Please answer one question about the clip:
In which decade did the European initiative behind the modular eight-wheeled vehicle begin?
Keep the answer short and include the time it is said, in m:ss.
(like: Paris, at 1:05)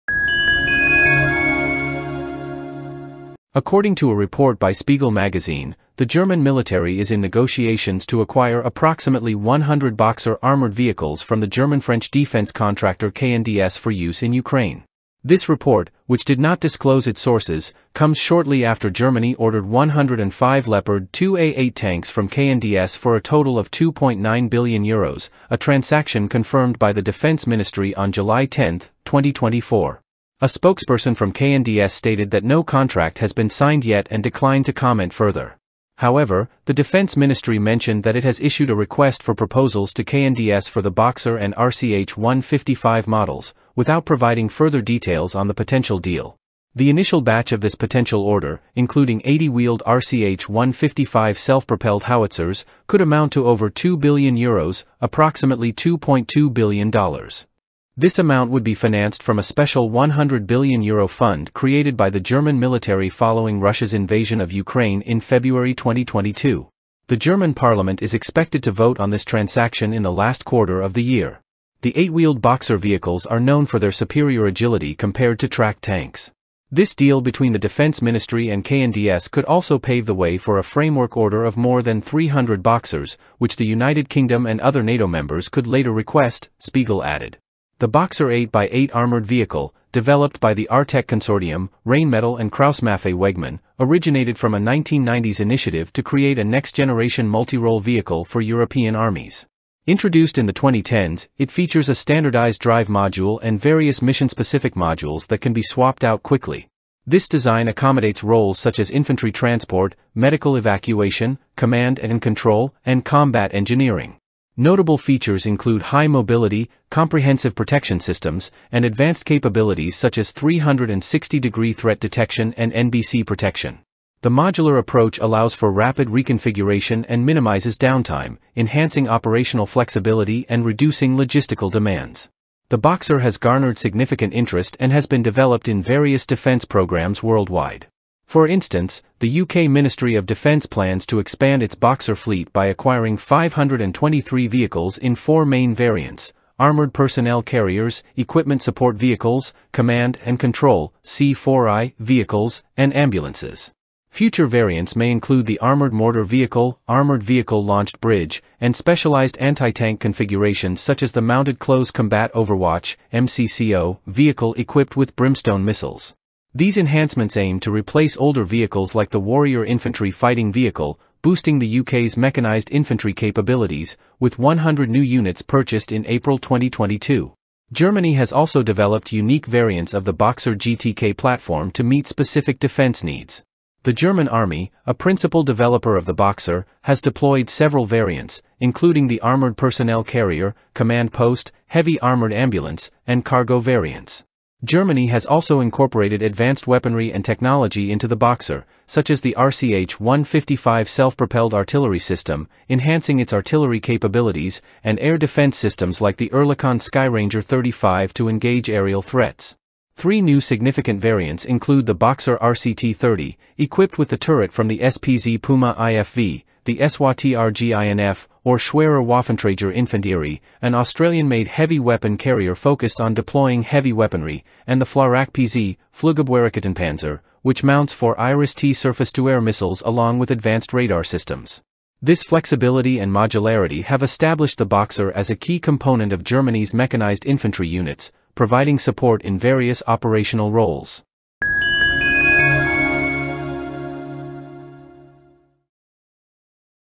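1990s, at 1:34.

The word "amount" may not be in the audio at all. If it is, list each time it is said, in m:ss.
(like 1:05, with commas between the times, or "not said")
0:53, 0:58.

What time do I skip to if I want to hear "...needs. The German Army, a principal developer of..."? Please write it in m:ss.
3:03.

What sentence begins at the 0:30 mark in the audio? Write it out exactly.
A spokesperson from KNDS stated that no contract has been signed yet and declined to comment further.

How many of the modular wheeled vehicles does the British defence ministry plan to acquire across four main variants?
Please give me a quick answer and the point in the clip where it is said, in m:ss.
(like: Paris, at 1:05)
523, at 2:23.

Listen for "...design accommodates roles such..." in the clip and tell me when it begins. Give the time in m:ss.
1:47.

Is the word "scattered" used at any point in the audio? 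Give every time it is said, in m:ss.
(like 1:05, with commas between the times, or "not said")
not said.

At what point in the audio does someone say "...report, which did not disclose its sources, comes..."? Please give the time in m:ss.
0:15.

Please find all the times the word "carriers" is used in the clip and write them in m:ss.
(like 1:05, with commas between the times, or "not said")
2:27, 3:10, 3:42.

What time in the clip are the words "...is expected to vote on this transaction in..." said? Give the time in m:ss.
1:08.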